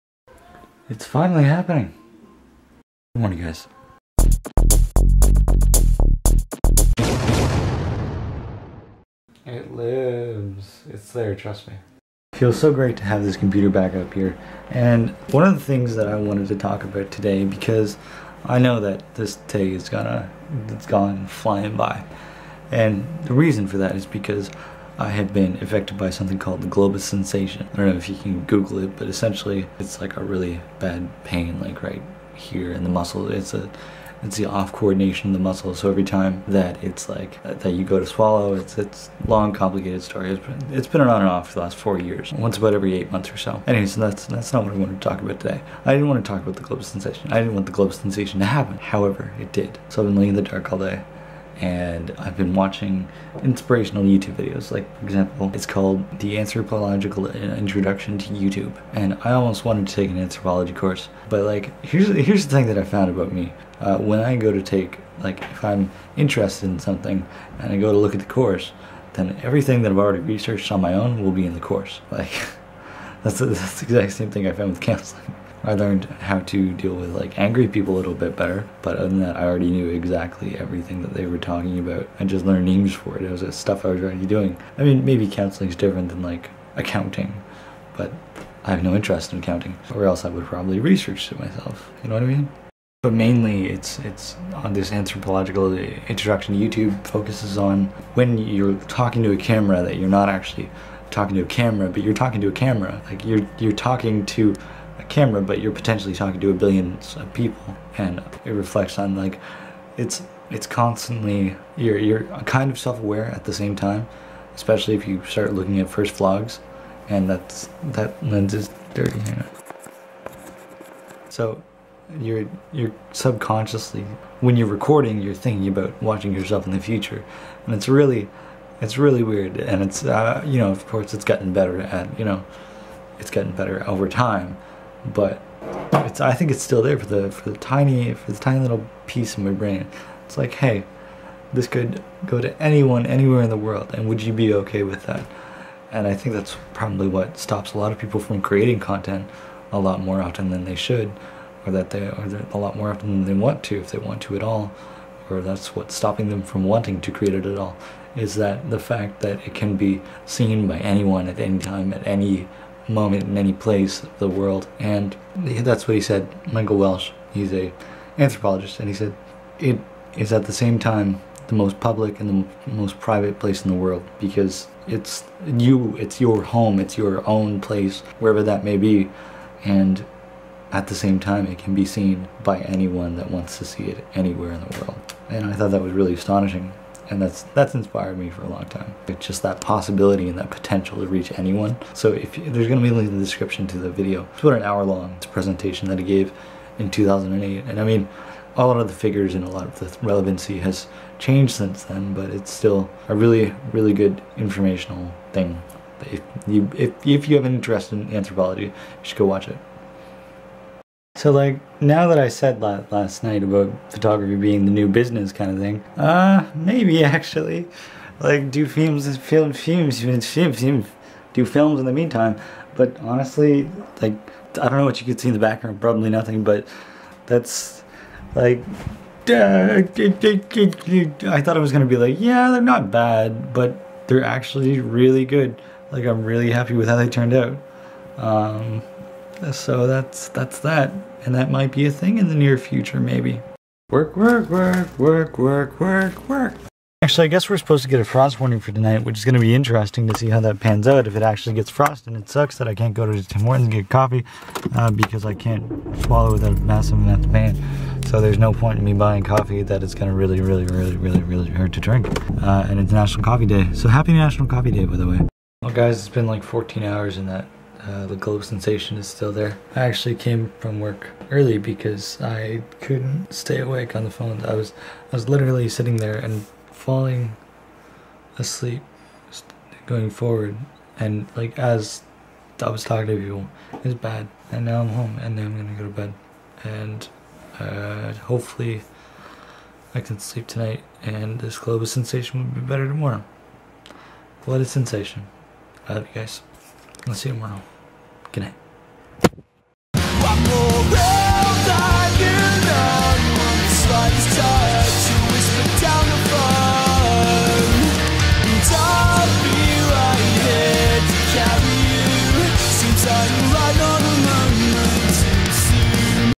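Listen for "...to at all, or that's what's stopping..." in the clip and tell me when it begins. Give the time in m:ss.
2:34.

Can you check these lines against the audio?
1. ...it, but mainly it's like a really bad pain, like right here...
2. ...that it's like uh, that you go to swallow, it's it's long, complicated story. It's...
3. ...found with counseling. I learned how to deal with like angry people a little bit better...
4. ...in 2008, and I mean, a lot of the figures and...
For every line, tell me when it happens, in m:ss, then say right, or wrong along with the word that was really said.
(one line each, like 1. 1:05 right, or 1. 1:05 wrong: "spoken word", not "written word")
1. 0:28 wrong: "essentially", not "mainly"
2. 0:36 right
3. 1:14 right
4. 3:16 right.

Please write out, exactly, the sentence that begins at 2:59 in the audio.
And at the same time, it can be seen by anyone that wants to see it anywhere in the world.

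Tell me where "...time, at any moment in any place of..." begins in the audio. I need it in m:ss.
2:41.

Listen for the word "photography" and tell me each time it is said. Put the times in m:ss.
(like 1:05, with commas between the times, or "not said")
3:33.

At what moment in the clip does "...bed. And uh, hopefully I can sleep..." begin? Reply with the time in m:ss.
4:45.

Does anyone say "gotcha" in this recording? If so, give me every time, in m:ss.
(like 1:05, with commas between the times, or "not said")
not said.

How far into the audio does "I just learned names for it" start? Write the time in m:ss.
1:22.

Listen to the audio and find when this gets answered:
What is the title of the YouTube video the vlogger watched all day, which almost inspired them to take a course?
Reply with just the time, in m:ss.
0:56.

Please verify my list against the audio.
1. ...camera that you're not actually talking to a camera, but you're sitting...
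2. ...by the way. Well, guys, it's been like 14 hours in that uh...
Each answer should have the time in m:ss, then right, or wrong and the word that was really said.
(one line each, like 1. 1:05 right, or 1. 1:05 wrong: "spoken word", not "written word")
1. 1:39 wrong: "talking", not "sitting"
2. 4:24 right.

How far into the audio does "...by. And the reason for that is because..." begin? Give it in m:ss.
0:21.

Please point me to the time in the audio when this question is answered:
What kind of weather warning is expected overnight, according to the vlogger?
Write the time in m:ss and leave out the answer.
4:08.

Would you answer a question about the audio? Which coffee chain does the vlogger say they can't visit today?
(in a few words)
Tim Hortons.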